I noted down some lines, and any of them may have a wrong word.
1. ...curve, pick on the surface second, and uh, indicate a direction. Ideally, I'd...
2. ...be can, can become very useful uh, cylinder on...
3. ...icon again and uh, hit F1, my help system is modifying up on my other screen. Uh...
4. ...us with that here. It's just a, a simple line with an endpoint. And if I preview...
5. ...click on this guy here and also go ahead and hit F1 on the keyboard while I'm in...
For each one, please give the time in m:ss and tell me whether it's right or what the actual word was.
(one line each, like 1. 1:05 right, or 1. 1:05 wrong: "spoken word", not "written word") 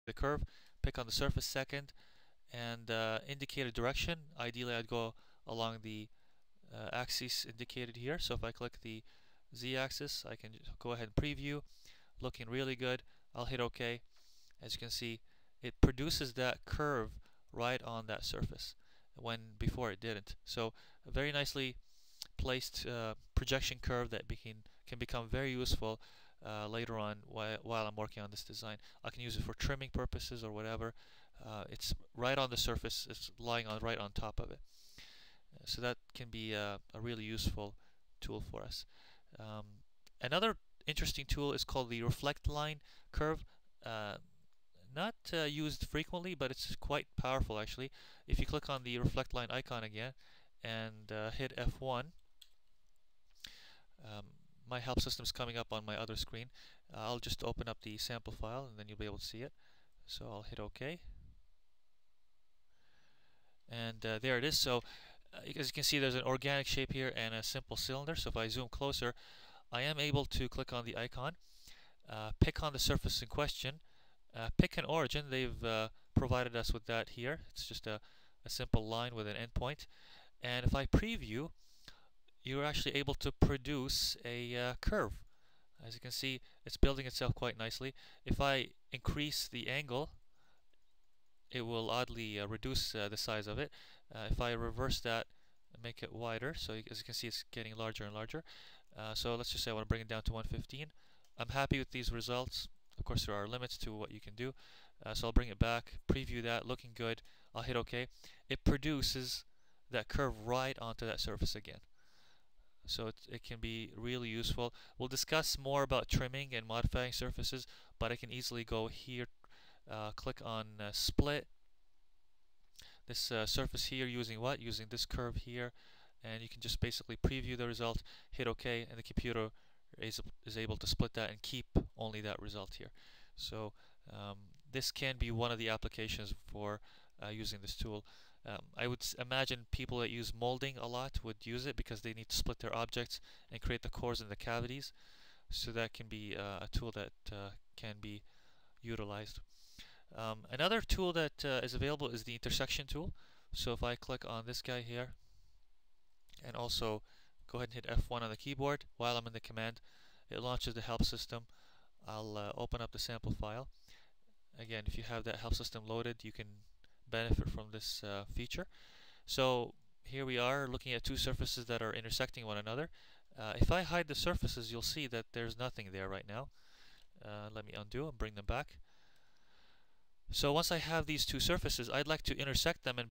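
1. 0:00 right
2. 0:24 wrong: "later", not "cylinder"
3. 0:49 wrong: "coming", not "modifying"
4. 1:16 right
5. 2:33 right.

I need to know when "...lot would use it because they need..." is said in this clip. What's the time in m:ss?
2:20.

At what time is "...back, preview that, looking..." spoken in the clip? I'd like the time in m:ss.
1:45.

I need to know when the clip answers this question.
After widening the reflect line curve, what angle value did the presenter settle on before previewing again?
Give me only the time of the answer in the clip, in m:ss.
1:40.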